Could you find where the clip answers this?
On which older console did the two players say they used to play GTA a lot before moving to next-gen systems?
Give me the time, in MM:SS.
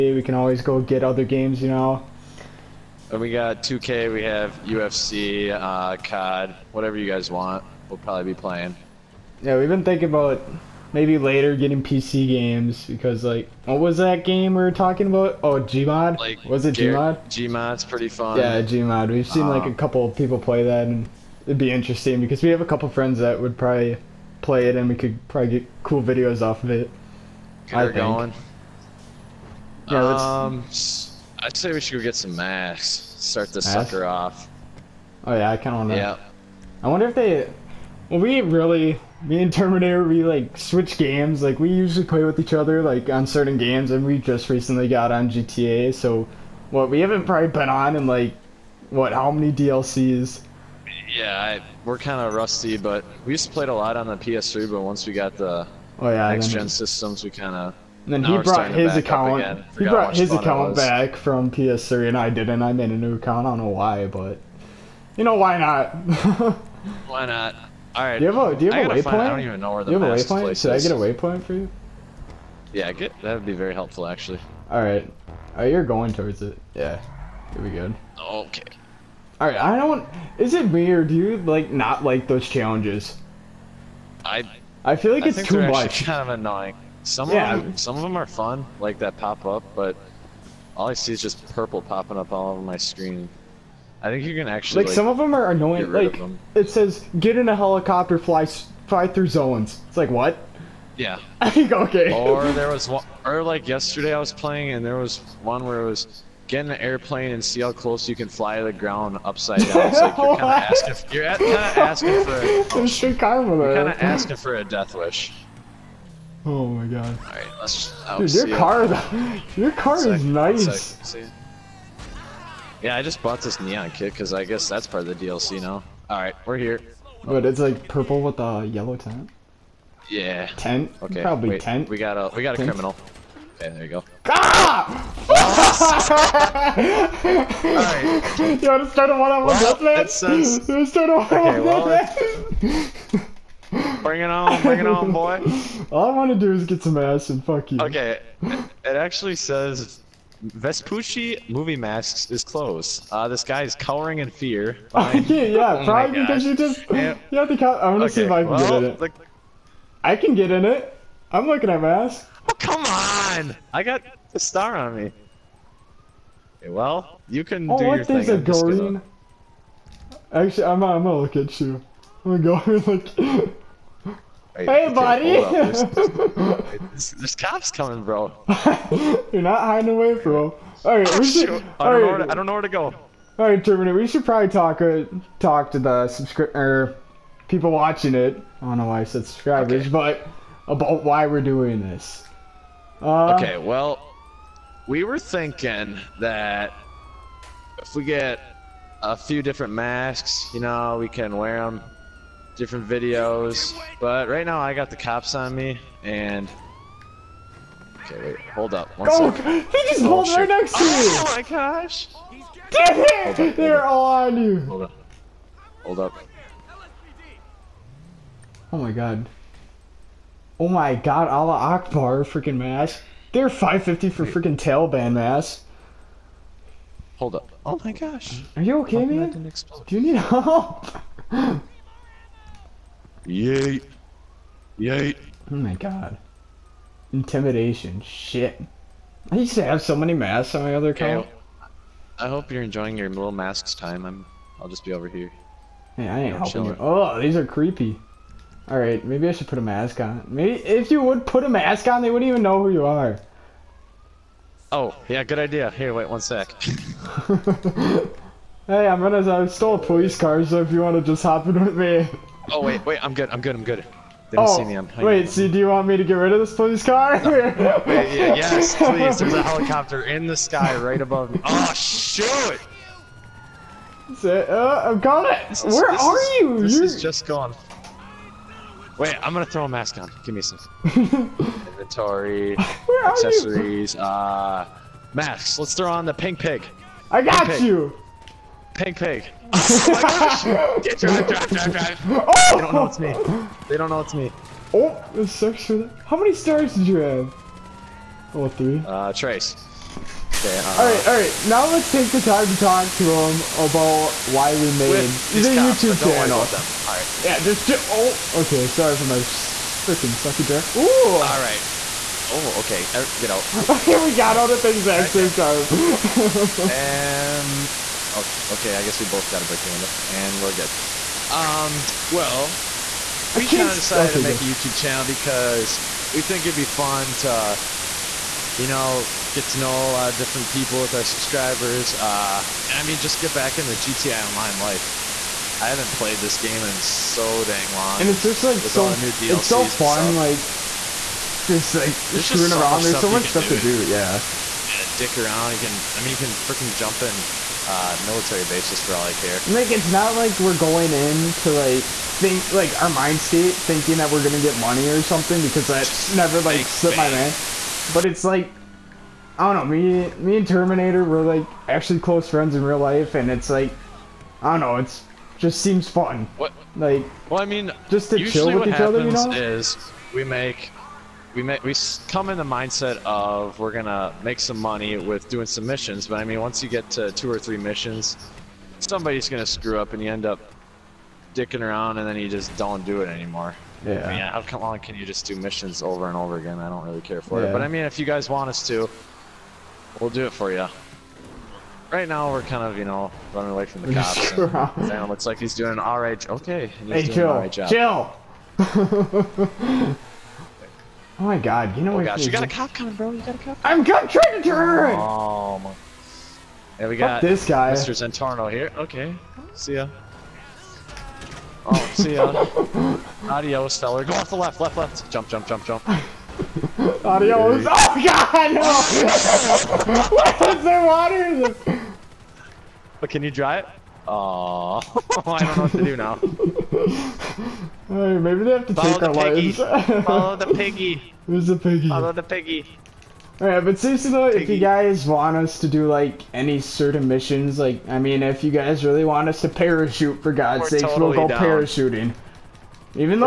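00:53.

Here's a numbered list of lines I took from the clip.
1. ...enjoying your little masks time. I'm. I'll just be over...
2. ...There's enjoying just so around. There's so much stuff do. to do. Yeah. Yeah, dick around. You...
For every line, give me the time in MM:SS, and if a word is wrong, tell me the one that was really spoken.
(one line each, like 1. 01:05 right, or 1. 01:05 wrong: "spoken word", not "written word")
1. 04:02 right
2. 05:42 wrong: "screwing", not "enjoying".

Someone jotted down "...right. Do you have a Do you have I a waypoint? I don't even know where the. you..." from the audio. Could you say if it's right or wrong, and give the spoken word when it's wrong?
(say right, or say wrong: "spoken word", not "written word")
right.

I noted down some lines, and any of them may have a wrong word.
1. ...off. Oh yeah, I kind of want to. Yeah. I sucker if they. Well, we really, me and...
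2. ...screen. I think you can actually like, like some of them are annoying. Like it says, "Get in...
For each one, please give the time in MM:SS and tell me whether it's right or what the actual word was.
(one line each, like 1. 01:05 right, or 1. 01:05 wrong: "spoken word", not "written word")
1. 00:34 wrong: "wonder", not "sucker"
2. 01:32 right.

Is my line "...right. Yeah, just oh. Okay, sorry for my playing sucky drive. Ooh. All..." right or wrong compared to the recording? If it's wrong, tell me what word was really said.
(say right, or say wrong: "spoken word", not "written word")
wrong: "freaking", not "playing".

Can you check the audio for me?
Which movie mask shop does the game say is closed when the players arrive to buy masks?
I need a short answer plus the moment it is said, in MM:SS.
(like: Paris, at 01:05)
Vespucci movie masks, at 02:30.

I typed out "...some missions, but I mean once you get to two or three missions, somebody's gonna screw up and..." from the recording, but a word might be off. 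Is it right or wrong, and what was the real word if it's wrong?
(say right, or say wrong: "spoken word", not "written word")
right.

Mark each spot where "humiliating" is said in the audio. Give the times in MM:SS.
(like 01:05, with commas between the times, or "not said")
not said.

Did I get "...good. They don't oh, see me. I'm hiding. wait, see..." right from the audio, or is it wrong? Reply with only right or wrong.
right.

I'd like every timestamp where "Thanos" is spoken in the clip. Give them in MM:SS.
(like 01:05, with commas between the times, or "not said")
not said.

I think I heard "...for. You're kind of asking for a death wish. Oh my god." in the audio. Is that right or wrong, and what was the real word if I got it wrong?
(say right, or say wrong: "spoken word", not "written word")
right.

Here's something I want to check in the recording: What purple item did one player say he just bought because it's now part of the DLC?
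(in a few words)
neon kit.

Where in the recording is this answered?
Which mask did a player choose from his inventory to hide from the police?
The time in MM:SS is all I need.
04:46.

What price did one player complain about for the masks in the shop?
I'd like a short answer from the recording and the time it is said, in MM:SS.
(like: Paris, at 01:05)
550, at 03:43.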